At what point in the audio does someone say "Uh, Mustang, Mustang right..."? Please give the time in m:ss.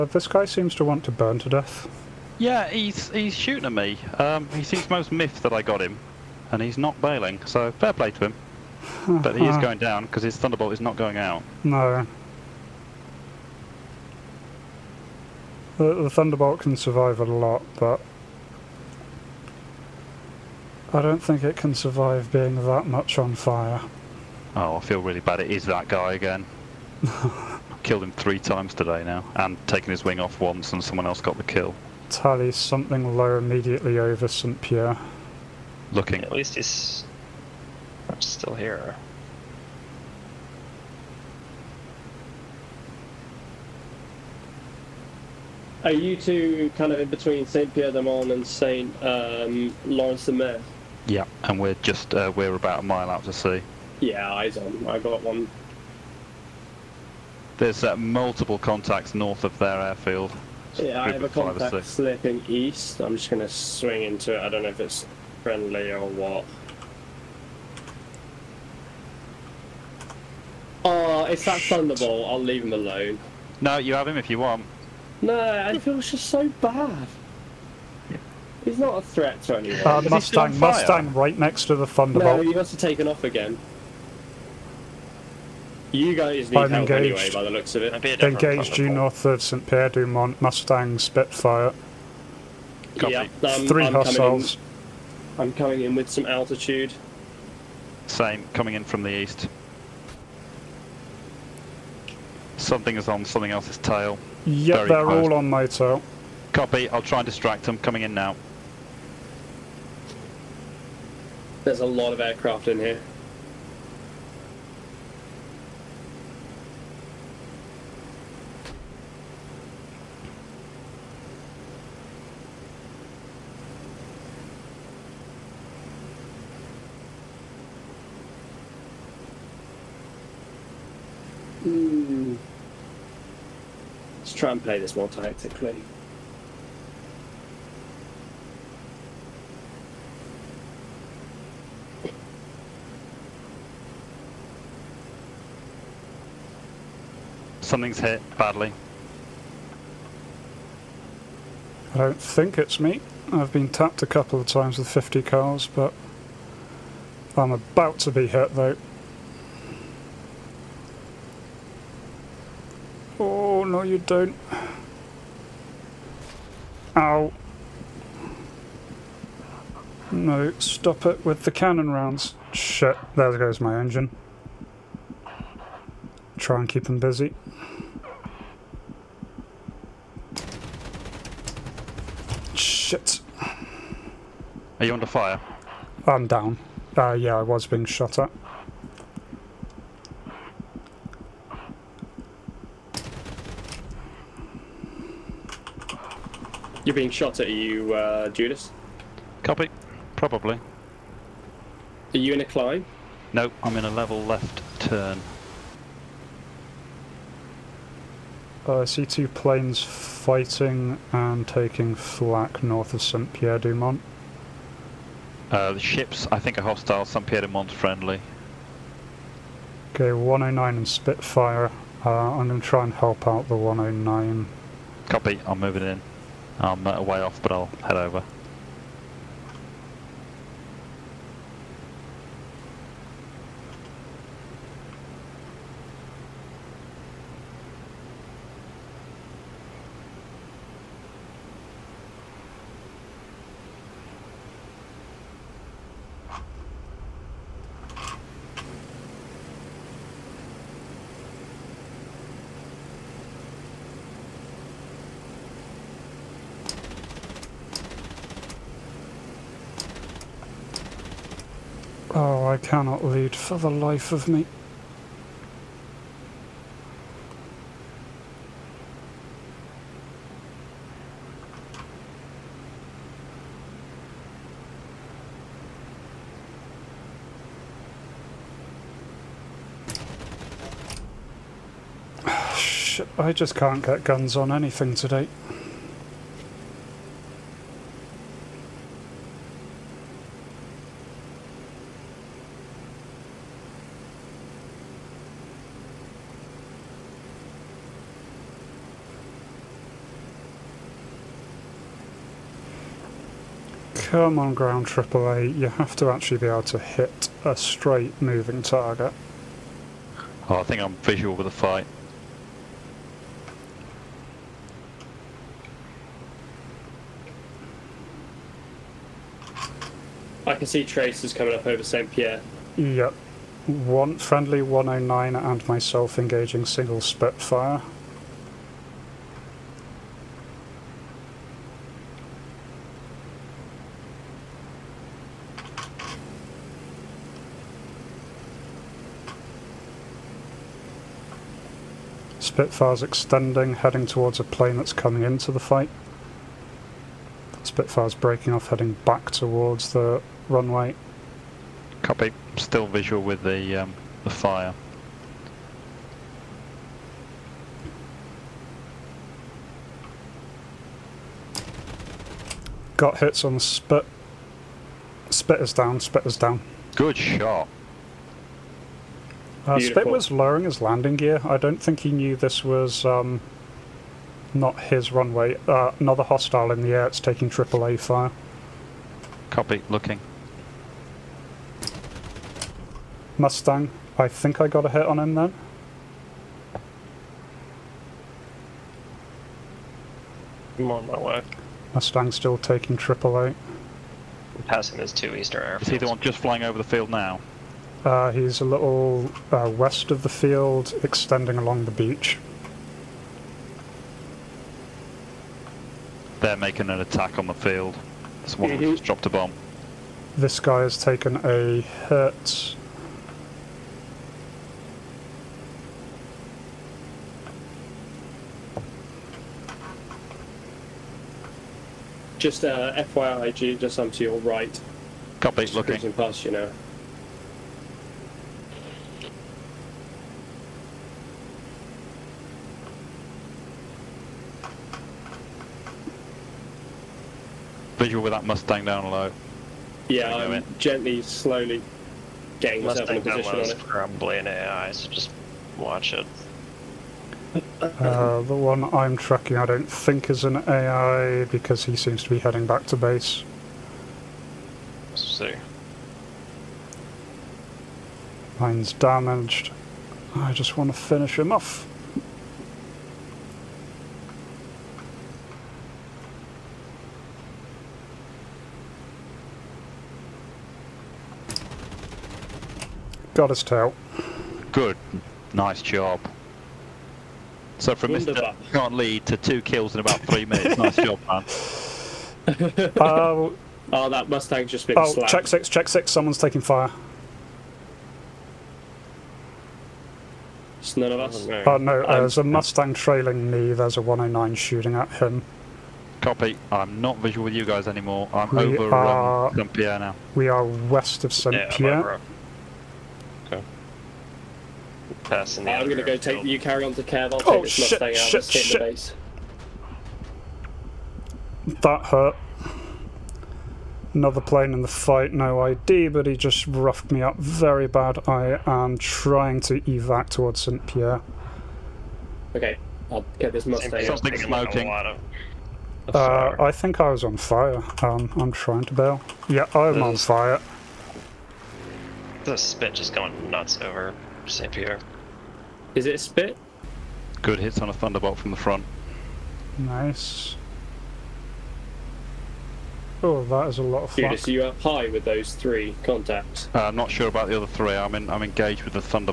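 1:19.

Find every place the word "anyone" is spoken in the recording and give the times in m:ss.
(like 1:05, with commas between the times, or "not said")
1:19.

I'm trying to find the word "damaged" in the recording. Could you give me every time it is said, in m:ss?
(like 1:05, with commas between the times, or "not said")
7:38.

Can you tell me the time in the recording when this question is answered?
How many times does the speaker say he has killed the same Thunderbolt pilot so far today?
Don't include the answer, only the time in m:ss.
0:28.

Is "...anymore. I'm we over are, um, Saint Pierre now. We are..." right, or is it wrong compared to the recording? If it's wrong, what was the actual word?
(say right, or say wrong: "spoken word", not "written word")
right.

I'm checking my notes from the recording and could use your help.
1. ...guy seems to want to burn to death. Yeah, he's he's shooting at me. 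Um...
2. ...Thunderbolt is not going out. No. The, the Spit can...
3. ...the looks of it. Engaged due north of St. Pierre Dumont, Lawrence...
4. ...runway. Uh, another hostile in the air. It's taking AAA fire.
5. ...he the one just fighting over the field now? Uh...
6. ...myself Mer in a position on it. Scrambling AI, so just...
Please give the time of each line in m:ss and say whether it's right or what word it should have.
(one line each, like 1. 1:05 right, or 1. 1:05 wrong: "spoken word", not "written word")
1. 0:00 right
2. 0:10 wrong: "Thunderbolt", not "Spit"
3. 1:27 wrong: "Mustang", not "Lawrence"
4. 6:15 right
5. 6:35 wrong: "flying", not "fighting"
6. 7:22 wrong: "Mustang", not "Mer".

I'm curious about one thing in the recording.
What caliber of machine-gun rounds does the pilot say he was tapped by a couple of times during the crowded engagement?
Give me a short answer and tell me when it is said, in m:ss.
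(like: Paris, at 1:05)
50 cal, at 2:34.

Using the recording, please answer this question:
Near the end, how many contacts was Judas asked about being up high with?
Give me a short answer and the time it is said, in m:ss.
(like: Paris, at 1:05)
3, at 9:05.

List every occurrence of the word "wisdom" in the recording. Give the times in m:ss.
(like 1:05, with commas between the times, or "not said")
not said.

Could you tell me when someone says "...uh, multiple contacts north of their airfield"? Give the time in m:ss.
0:57.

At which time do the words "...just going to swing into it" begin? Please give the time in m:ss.
1:03.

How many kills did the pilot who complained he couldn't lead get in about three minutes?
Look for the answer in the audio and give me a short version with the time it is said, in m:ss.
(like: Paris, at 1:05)
2, at 7:59.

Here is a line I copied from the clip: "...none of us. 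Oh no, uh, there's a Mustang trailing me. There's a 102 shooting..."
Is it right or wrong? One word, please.
wrong.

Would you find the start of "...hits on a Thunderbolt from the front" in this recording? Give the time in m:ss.
8:57.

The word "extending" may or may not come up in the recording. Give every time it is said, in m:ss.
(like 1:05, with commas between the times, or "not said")
5:43, 6:41.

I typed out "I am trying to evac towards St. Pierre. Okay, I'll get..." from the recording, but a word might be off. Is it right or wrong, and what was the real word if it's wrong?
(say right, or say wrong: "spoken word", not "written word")
right.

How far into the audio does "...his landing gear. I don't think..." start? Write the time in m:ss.
6:10.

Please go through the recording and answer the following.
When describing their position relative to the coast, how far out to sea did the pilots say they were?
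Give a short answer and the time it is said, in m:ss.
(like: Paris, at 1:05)
a mile, at 0:52.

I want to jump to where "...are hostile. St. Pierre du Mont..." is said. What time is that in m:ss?
3:36.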